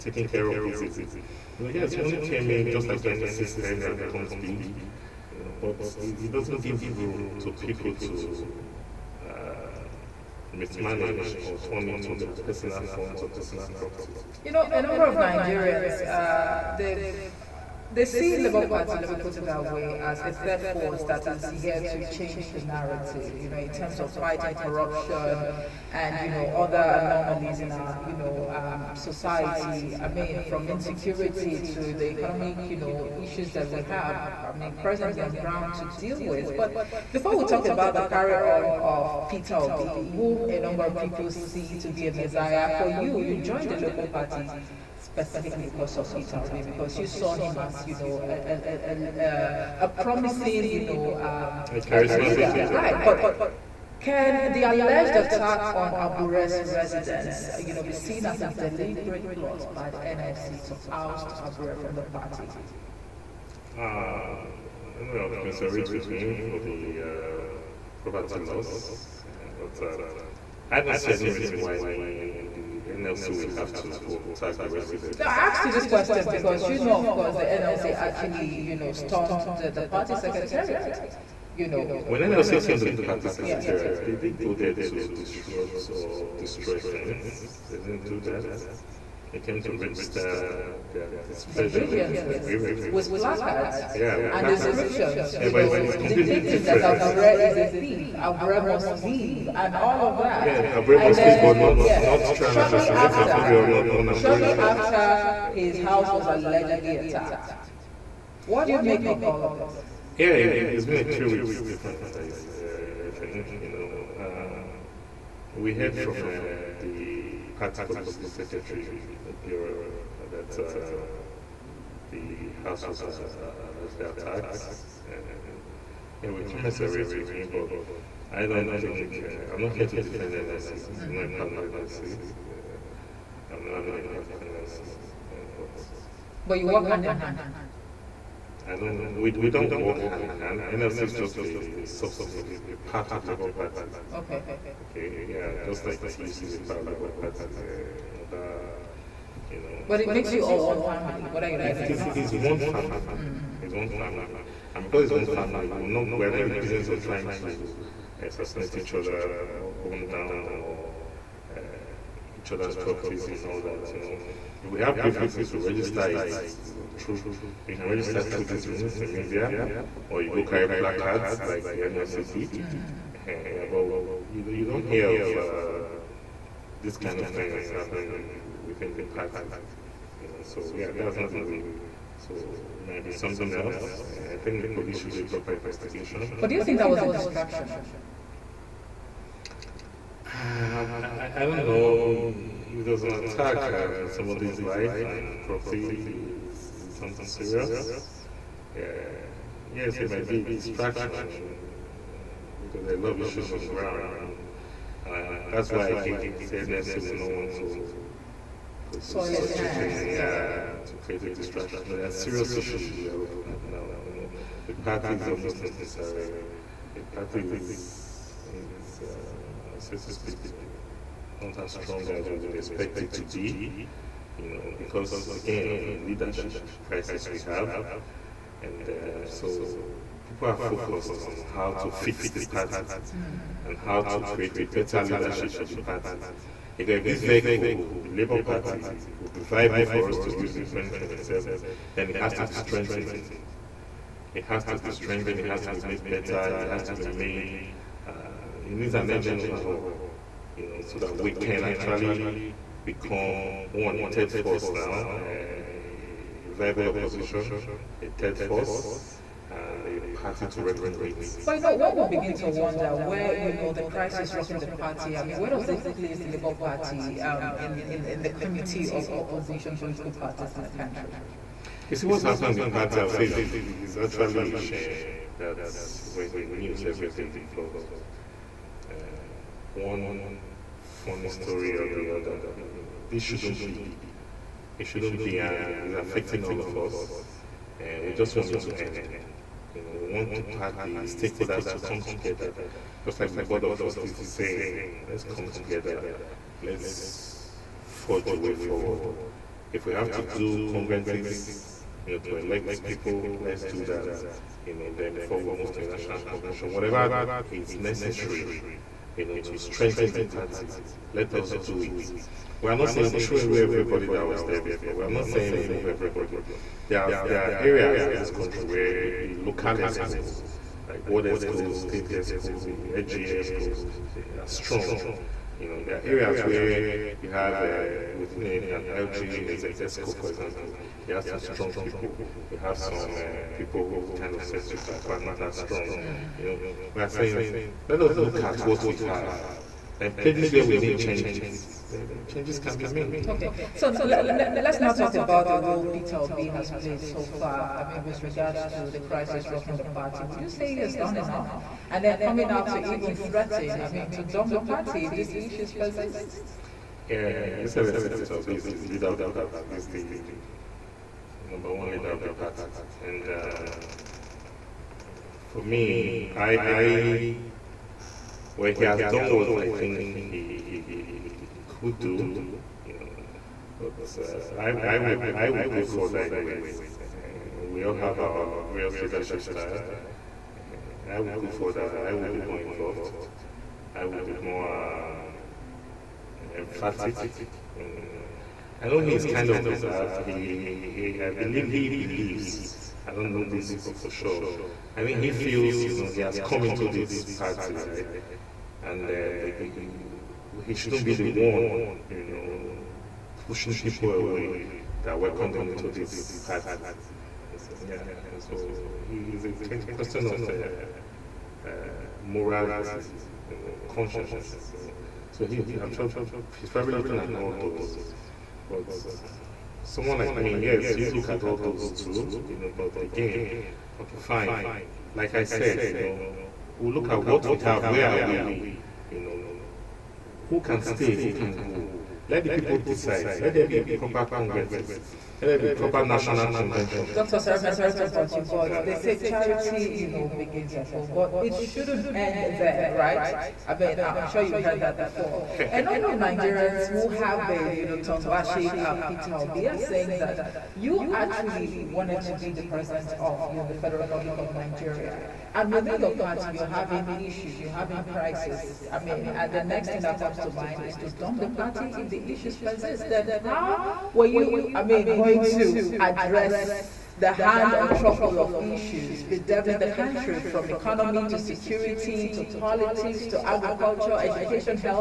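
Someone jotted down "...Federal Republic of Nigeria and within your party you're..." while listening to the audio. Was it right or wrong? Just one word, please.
right.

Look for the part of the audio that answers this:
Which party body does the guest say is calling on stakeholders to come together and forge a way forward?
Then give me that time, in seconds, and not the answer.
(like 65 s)
293 s.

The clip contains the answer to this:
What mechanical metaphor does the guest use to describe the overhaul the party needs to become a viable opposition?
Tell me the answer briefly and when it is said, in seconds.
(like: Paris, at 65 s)
Engine overhaul, at 249 s.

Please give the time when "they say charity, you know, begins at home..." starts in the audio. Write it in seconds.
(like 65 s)
438 s.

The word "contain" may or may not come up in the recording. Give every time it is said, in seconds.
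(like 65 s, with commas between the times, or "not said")
not said.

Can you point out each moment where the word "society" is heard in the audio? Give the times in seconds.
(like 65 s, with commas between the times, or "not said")
28 s.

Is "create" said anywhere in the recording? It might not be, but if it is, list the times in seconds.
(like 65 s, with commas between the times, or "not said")
211 s, 234 s.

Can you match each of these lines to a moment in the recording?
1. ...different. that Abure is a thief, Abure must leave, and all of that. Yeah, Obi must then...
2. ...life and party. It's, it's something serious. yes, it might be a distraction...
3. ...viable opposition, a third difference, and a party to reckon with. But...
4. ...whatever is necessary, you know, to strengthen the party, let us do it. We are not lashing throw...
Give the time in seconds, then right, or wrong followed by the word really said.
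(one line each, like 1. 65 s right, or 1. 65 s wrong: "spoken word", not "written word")
1. 96 s wrong: "Abure", not "Obi"
2. 194 s wrong: "property", not "party"
3. 256 s wrong: "force", not "difference"
4. 306 s wrong: "saying", not "lashing".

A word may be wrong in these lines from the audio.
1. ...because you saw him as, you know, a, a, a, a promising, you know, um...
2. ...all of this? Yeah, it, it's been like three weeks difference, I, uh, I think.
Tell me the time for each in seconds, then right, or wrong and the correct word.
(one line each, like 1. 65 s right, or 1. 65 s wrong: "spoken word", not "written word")
1. 46 s right
2. 109 s right.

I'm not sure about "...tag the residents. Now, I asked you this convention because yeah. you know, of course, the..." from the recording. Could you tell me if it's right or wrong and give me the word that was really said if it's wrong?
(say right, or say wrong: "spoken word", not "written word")
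wrong: "question", not "convention".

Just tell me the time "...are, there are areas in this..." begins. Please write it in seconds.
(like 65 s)
317 s.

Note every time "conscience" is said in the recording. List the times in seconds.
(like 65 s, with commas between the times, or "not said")
413 s.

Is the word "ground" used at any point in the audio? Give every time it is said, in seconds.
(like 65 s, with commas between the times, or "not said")
35 s, 203 s.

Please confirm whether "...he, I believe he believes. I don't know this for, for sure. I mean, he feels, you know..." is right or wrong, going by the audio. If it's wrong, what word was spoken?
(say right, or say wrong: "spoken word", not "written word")
right.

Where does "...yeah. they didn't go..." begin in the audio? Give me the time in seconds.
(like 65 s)
83 s.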